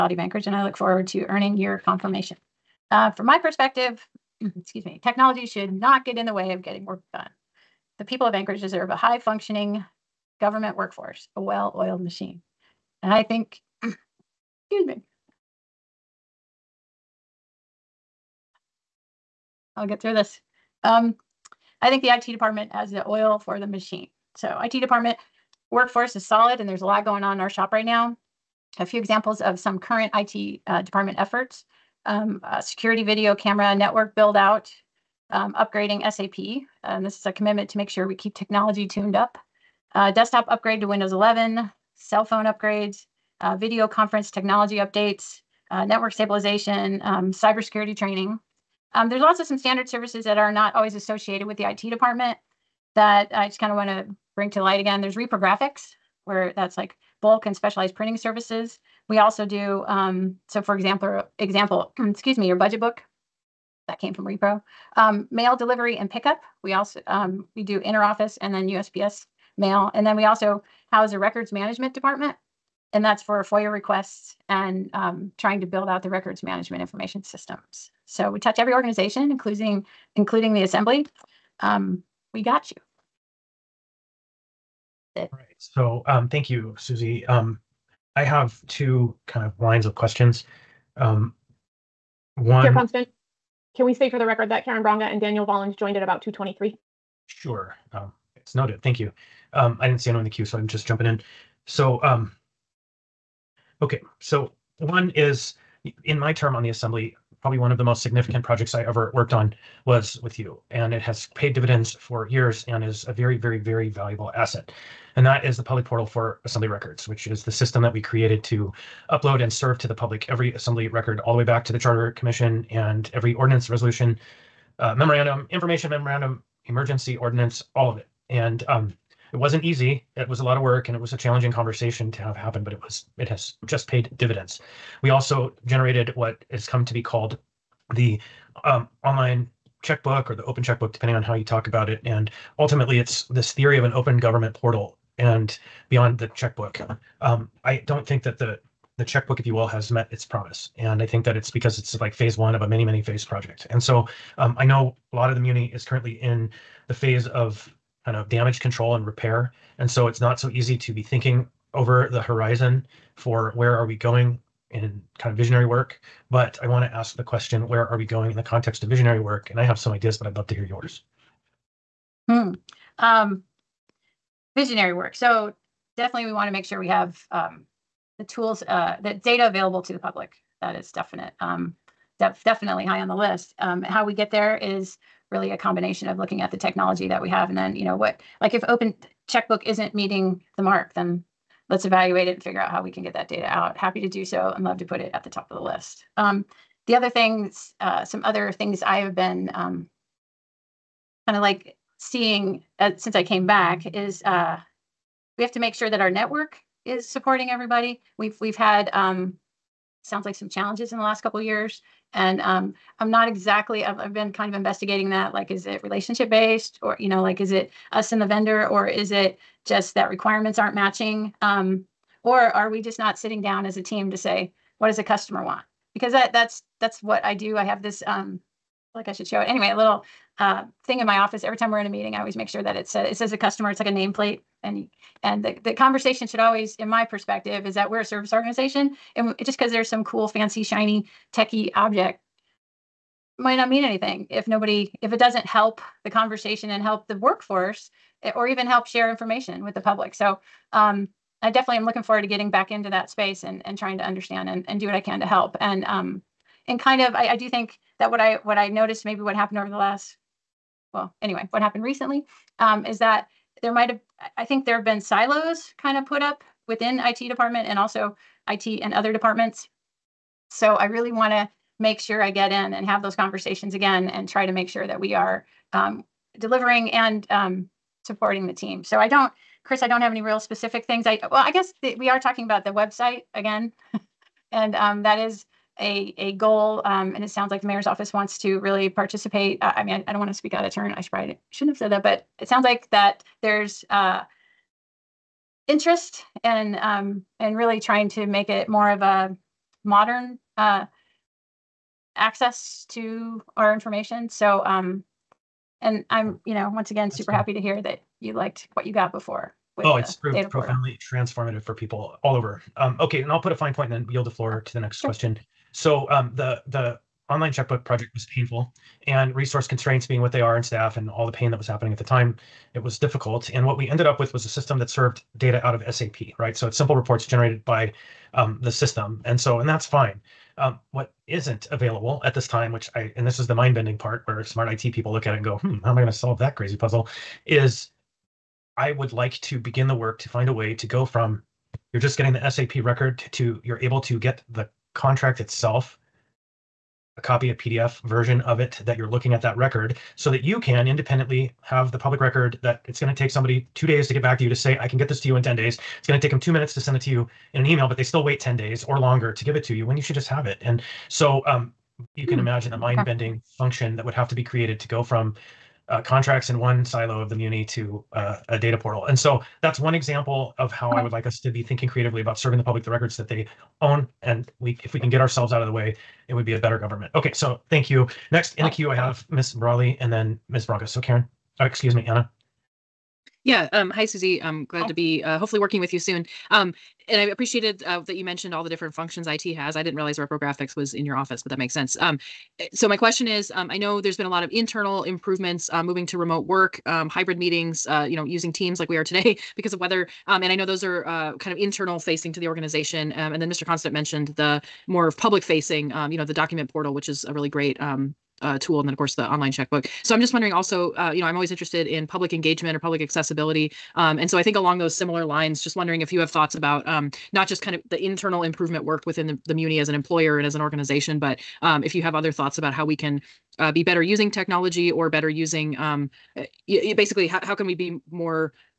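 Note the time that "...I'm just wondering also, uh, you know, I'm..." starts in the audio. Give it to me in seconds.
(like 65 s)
410 s.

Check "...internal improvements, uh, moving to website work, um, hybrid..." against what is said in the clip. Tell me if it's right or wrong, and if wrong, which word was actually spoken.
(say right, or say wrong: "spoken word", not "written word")
wrong: "remote", not "website".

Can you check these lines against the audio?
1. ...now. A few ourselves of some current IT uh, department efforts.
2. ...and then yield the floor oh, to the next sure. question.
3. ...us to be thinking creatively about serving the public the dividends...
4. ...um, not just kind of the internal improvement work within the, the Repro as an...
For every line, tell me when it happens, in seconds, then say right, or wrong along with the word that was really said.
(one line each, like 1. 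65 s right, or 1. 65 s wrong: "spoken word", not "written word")
1. 27 s wrong: "examples", not "ourselves"
2. 313 s right
3. 371 s wrong: "records", not "dividends"
4. 416 s wrong: "Muni", not "Repro".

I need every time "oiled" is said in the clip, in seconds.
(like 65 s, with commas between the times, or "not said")
11 s.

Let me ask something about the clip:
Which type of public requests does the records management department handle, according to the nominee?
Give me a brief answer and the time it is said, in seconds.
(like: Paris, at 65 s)
FOIA requests, at 73 s.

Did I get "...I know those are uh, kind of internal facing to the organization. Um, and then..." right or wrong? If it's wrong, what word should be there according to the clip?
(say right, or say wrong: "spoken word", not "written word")
right.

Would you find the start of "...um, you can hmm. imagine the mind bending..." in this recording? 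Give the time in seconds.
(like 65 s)
361 s.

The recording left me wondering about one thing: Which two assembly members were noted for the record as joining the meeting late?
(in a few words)
Karen Bronga and Daniel Volland.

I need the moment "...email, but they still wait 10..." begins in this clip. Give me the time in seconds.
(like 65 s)
357 s.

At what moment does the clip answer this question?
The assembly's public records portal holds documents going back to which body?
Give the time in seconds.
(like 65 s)
121 s.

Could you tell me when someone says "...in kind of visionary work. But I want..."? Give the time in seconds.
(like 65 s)
164 s.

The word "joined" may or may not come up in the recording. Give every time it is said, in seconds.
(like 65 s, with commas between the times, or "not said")
95 s.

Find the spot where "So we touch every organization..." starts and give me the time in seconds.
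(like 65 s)
78 s.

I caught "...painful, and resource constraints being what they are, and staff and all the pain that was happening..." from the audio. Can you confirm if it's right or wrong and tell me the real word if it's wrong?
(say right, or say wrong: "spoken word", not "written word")
right.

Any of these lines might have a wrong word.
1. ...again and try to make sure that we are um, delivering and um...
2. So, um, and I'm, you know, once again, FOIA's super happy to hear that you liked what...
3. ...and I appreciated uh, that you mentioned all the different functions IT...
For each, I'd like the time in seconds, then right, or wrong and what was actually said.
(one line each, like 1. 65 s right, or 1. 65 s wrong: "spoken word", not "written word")
1. 273 s right
2. 304 s wrong: "That", not "FOIA"
3. 387 s right.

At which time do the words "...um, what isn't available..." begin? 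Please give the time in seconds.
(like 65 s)
330 s.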